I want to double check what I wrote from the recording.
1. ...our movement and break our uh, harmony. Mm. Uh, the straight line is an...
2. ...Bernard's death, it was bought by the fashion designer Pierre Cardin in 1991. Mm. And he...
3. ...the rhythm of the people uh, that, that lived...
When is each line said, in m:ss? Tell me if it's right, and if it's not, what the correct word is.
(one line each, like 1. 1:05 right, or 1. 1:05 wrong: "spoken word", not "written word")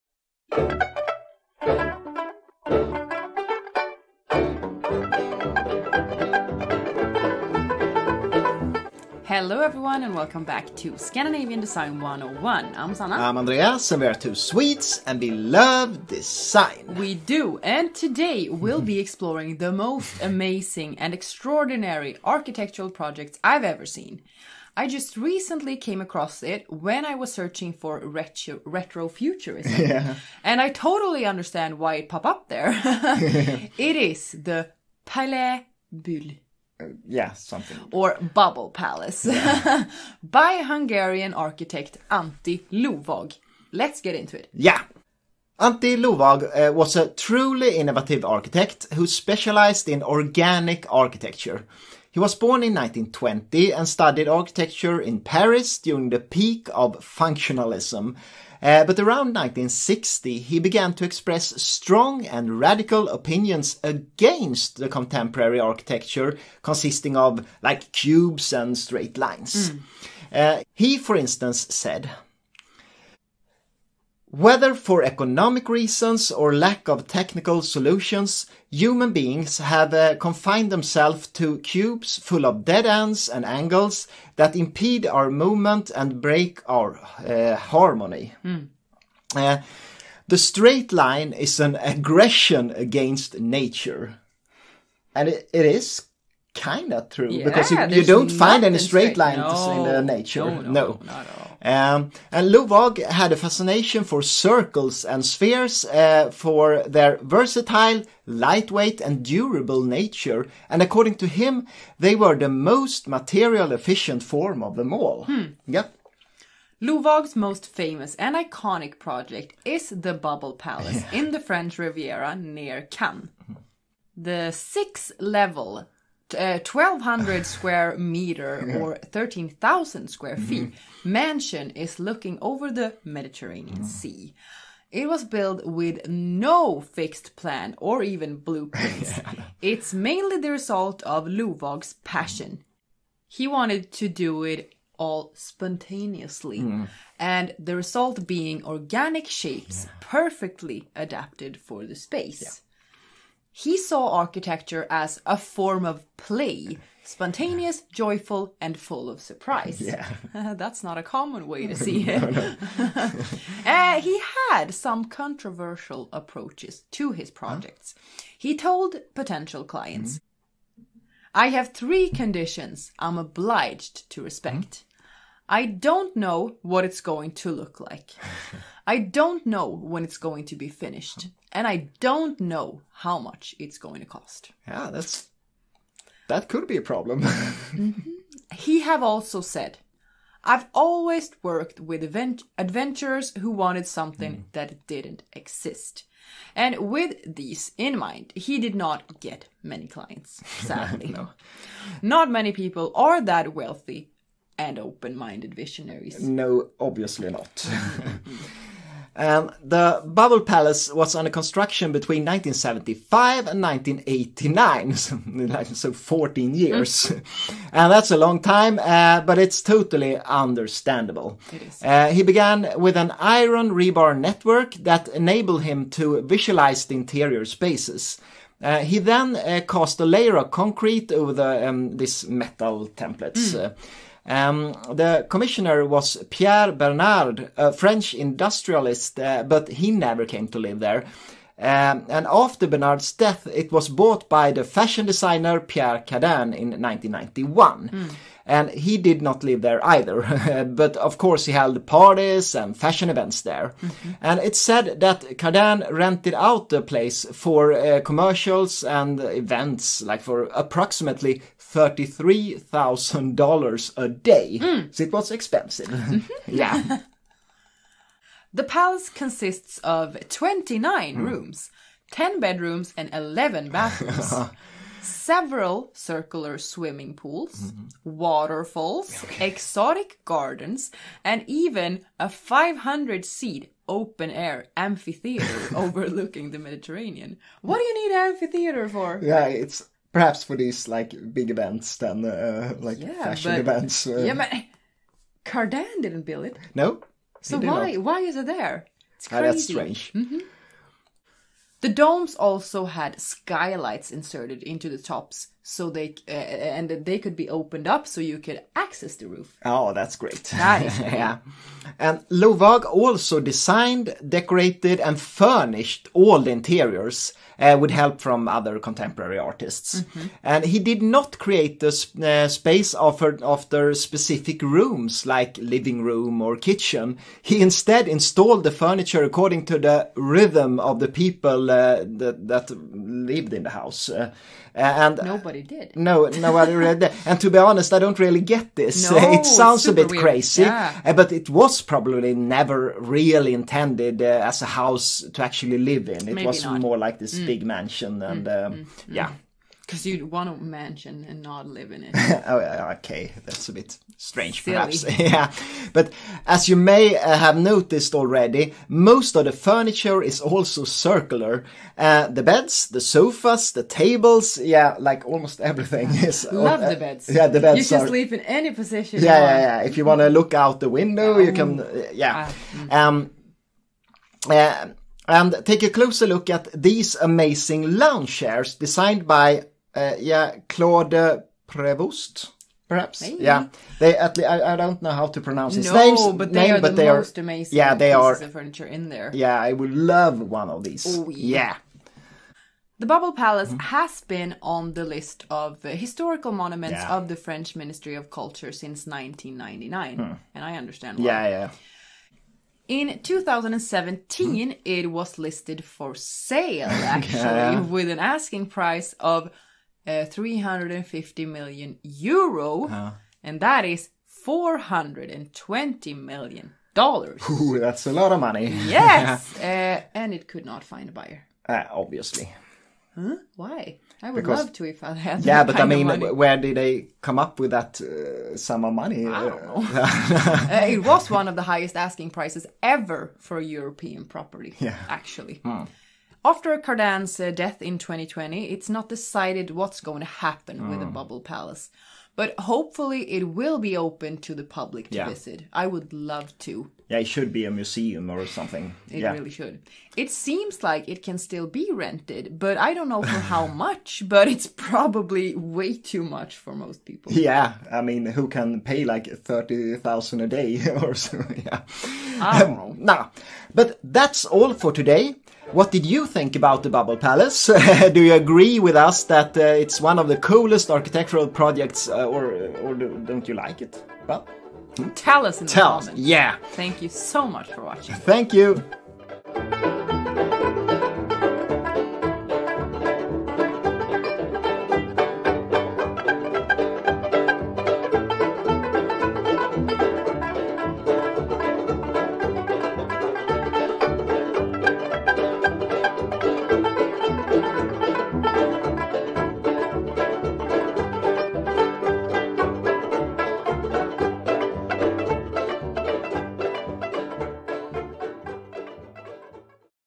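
1. 1:25 right
2. 4:02 right
3. 5:29 right.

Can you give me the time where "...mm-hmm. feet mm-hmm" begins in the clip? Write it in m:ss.
2:10.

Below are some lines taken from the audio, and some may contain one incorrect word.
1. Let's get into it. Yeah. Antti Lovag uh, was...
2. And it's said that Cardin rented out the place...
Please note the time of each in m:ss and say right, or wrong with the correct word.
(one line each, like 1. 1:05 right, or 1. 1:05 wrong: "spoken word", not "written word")
1. 0:43 right
2. 4:14 right.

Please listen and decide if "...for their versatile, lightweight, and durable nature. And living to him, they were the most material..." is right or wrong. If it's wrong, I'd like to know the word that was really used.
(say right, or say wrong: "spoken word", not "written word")
wrong: "according", not "living".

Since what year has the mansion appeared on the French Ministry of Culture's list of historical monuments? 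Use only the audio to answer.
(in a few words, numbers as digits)
1999.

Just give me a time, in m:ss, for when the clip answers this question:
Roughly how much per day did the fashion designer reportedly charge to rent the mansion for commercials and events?
4:21.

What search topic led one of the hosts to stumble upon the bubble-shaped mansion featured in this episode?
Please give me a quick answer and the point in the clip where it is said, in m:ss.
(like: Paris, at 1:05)
retro futurism, at 0:28.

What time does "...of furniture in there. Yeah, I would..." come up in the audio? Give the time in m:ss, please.
6:28.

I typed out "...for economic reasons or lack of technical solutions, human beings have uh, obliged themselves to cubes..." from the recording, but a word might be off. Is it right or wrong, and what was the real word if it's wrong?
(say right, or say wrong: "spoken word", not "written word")
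wrong: "confined", not "obliged".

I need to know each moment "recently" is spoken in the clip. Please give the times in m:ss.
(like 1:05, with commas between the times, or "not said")
0:25.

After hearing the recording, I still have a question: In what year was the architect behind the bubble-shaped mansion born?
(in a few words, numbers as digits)
1920.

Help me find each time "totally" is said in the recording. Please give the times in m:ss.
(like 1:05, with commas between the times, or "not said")
0:30, 3:39.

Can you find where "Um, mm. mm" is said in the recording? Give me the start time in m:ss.
5:48.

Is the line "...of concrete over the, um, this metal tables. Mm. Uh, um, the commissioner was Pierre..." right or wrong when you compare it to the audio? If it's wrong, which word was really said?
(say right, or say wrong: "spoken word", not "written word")
wrong: "templates", not "tables".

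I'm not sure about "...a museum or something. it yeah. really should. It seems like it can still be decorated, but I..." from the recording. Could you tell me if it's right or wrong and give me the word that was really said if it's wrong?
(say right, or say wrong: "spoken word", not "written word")
wrong: "rented", not "decorated".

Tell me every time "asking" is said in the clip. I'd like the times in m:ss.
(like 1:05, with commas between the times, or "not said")
6:48, 7:11.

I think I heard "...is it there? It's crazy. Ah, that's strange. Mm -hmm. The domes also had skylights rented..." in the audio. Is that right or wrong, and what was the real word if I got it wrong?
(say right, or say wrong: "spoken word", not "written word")
wrong: "inserted", not "rented".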